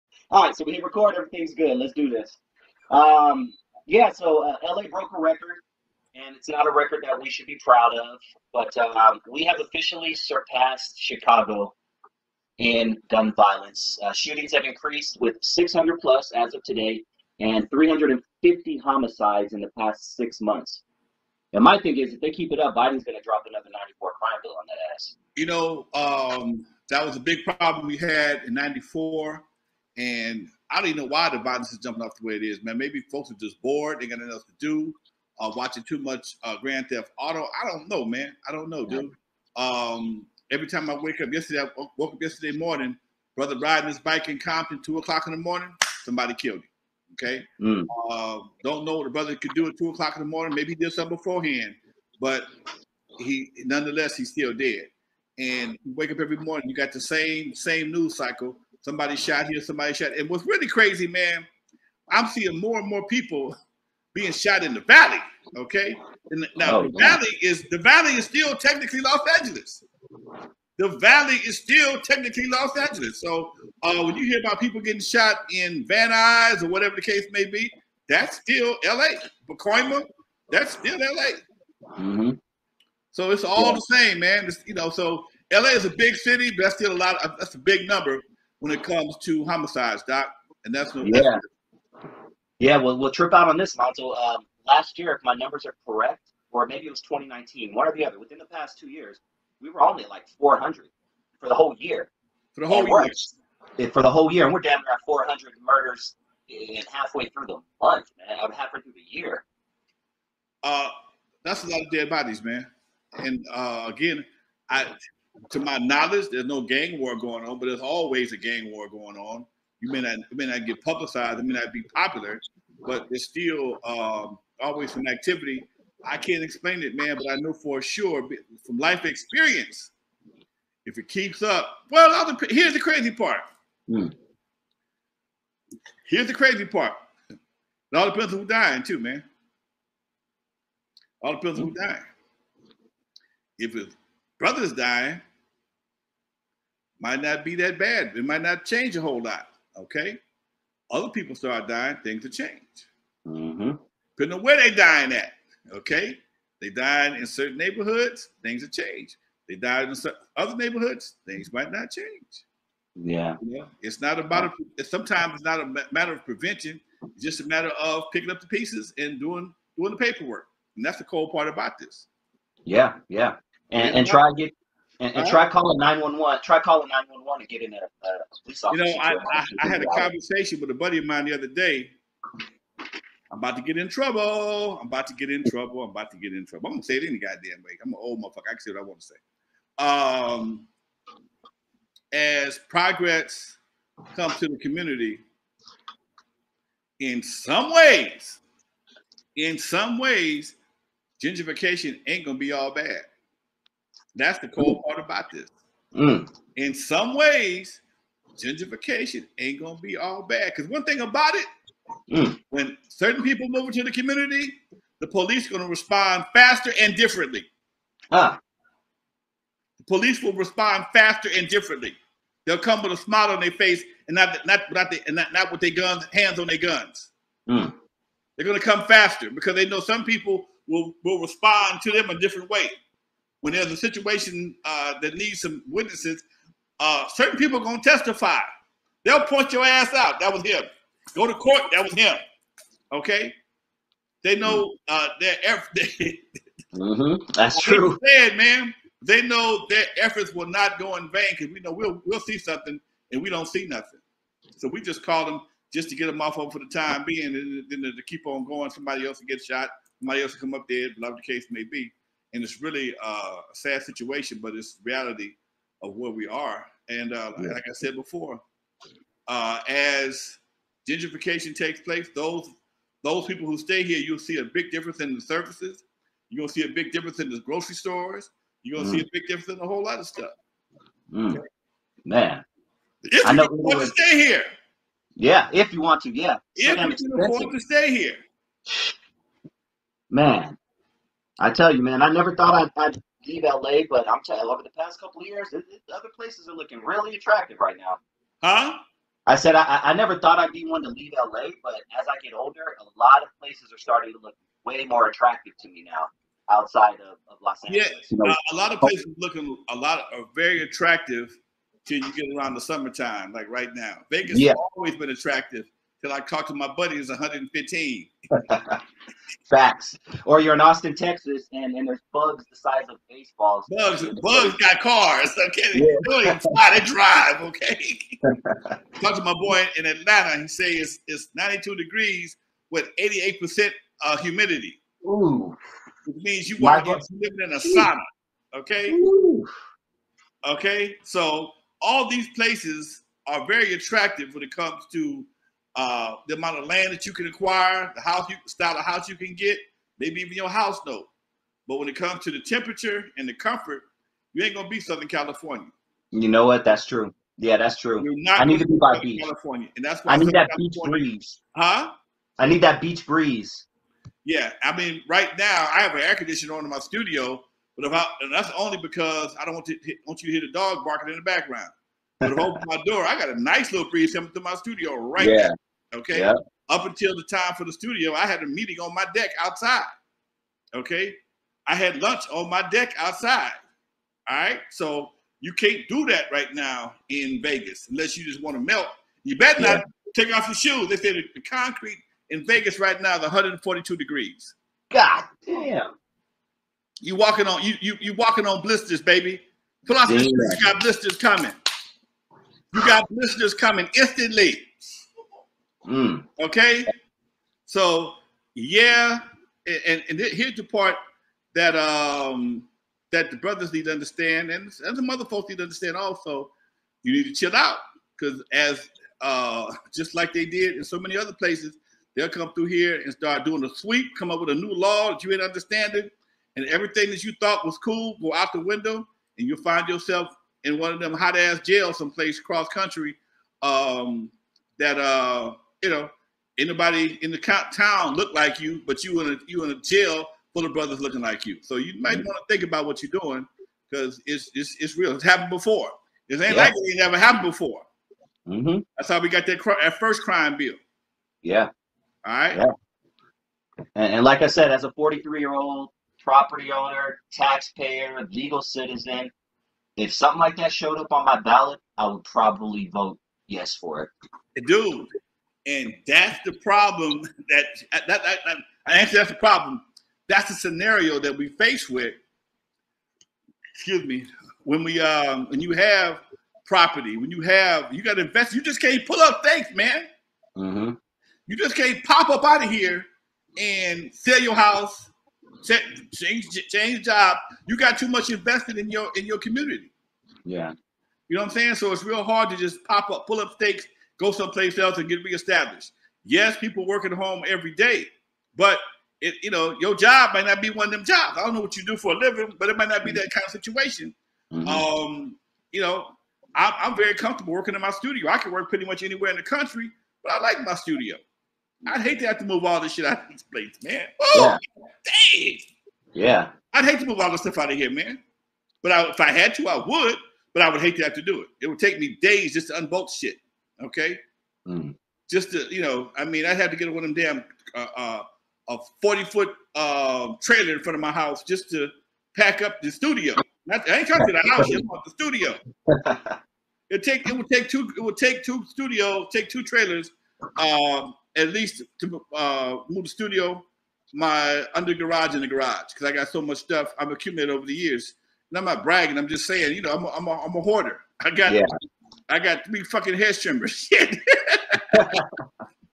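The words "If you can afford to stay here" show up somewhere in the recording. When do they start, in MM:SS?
04:46.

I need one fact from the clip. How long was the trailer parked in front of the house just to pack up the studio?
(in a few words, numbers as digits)
40 foot.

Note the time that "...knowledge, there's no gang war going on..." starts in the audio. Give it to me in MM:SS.
01:55.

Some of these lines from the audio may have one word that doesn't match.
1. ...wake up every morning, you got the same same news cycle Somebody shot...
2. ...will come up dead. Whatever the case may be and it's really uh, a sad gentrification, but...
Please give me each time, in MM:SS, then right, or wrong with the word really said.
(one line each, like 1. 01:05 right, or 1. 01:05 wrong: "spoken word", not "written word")
1. 00:55 right
2. 04:20 wrong: "situation", not "gentrification".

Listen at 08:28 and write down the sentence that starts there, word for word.
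I can work pretty much anywhere in the country, but I like my studio.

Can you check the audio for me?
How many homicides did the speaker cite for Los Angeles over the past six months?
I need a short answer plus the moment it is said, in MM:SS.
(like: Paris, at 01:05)
350, at 00:17.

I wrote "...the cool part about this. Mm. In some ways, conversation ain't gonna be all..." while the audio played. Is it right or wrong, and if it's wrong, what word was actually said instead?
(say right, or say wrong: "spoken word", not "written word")
wrong: "gentrification", not "conversation".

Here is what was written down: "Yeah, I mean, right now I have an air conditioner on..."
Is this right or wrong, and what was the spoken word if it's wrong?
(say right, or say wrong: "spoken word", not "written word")
right.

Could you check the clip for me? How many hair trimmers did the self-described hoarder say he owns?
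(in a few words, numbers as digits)
3.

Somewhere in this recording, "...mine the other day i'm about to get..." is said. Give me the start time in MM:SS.
03:01.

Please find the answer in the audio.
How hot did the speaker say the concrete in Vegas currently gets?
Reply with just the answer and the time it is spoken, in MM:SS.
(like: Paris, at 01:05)
142 degrees, at 06:33.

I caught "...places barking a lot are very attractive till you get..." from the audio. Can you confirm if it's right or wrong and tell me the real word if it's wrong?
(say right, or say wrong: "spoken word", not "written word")
wrong: "looking", not "barking".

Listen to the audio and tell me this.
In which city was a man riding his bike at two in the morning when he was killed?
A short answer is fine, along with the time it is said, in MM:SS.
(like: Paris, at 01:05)
Compton, at 00:44.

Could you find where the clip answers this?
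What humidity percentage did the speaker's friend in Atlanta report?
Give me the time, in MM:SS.
05:32.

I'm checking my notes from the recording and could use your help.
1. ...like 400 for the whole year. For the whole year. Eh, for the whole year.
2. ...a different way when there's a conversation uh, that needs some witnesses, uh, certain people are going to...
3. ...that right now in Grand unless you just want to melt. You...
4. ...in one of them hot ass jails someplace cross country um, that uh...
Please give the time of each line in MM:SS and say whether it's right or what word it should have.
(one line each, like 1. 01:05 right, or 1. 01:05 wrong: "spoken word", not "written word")
1. 01:40 right
2. 03:52 wrong: "situation", not "conversation"
3. 06:26 wrong: "Vegas", not "Grand"
4. 07:10 right.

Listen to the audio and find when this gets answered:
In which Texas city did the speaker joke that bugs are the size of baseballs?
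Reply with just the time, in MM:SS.
05:20.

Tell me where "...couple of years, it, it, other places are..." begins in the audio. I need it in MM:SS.
04:54.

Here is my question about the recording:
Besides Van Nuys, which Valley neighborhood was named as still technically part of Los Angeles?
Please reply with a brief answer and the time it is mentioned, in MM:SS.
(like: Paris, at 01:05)
Pacoima, at 01:19.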